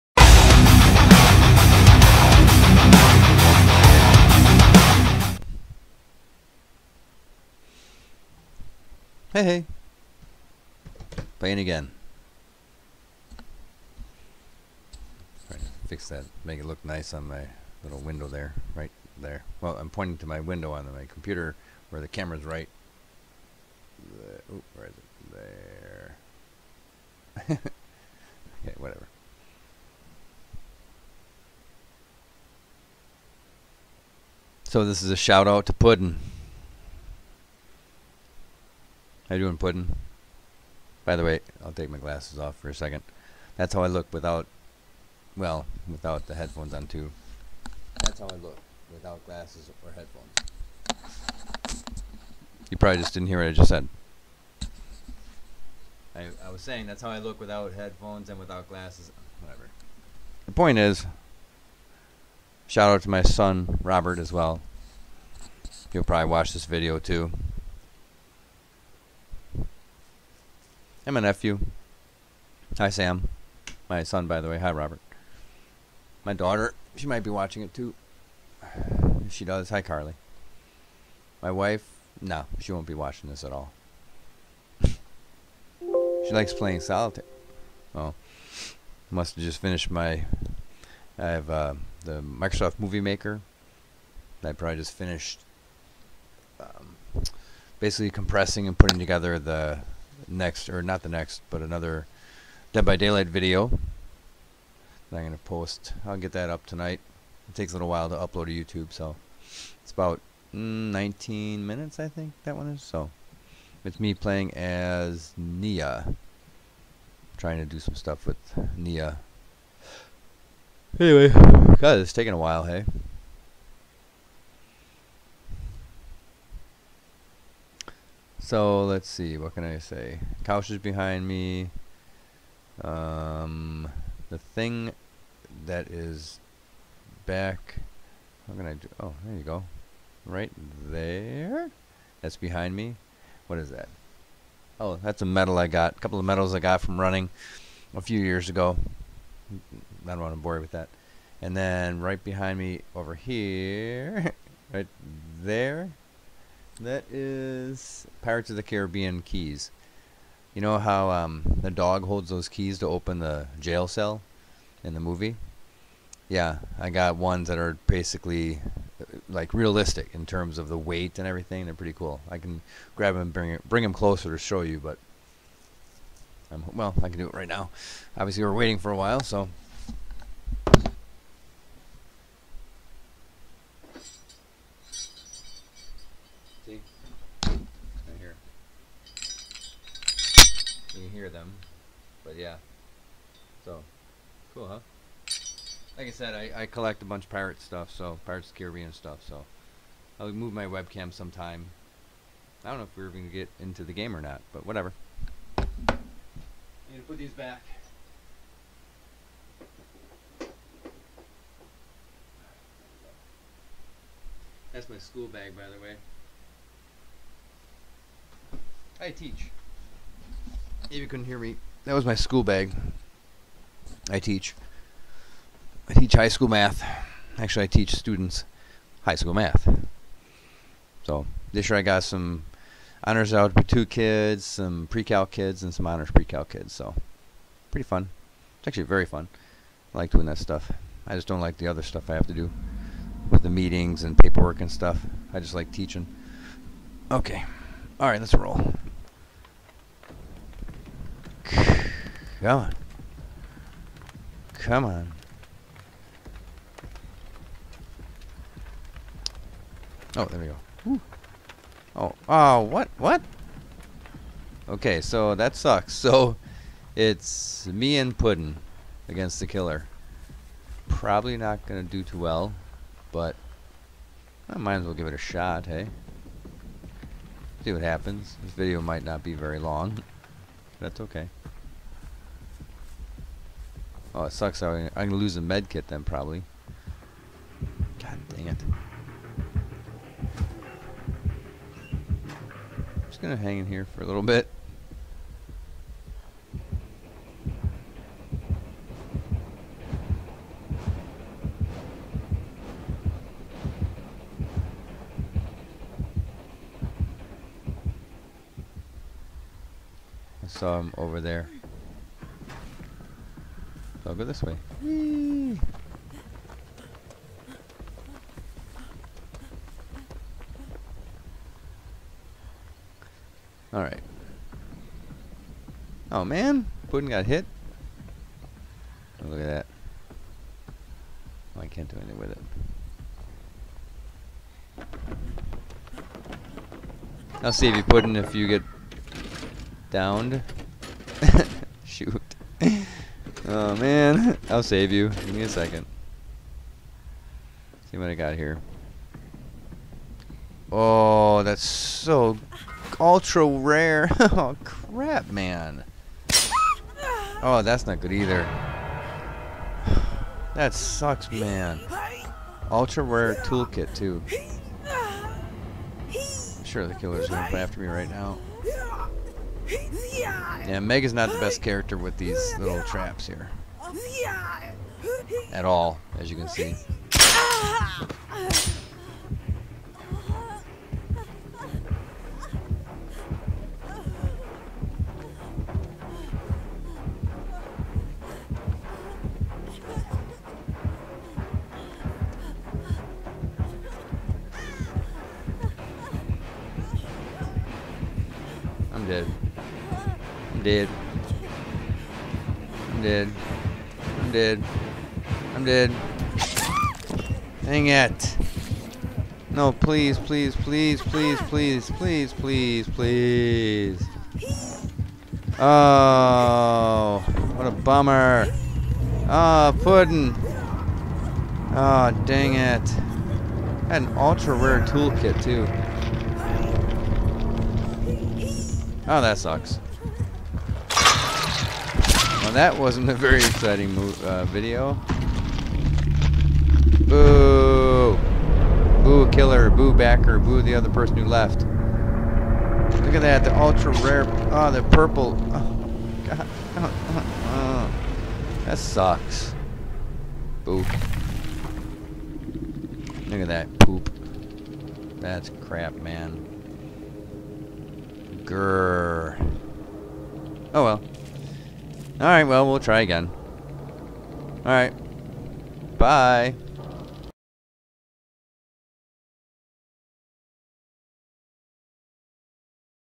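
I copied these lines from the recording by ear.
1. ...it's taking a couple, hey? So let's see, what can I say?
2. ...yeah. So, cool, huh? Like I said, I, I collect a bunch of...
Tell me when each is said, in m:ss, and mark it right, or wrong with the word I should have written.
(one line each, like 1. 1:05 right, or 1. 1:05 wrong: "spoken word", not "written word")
1. 2:01 wrong: "while", not "couple"
2. 3:12 right.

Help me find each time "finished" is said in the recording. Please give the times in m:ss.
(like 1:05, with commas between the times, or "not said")
1:29, 1:34.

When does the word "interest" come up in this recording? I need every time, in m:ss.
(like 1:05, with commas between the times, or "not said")
not said.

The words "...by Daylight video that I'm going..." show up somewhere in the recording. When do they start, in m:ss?
1:42.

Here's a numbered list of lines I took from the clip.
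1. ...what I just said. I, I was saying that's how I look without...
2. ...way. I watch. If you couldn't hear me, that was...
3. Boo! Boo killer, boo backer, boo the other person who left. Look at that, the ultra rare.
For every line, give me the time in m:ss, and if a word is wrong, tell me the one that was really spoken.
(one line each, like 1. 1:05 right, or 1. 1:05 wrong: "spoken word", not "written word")
1. 0:53 right
2. 3:35 wrong: "teach", not "watch"
3. 7:17 right.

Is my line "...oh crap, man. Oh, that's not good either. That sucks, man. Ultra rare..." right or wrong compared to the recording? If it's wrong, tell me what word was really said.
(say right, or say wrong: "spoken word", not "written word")
right.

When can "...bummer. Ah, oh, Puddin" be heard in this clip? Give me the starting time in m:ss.
6:57.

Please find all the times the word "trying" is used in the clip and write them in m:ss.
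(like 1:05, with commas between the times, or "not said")
0:15, 1:57.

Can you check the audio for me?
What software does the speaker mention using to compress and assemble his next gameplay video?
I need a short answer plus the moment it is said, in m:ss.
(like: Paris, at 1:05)
Microsoft Movie Maker, at 1:32.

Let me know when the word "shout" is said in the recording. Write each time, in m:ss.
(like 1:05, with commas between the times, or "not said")
0:35, 1:02.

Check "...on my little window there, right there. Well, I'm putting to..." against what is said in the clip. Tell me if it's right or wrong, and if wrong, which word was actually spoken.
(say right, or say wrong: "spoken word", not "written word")
wrong: "pointing", not "putting".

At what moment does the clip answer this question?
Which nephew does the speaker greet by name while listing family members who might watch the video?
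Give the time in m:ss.
1:12.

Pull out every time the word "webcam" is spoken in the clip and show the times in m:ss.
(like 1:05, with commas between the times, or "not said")
3:20.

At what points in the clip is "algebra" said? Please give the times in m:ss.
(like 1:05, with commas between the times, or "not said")
3:53.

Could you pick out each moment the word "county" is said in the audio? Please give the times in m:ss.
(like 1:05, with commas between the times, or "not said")
not said.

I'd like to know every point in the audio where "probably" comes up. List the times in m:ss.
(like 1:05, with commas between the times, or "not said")
0:52, 1:06, 1:34, 4:30, 4:46.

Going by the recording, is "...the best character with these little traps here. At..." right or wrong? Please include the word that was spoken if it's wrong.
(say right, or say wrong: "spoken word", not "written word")
right.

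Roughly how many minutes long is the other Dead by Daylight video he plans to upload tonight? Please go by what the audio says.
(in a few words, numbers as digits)
19.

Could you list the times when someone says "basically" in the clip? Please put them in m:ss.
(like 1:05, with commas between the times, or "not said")
1:37, 2:47.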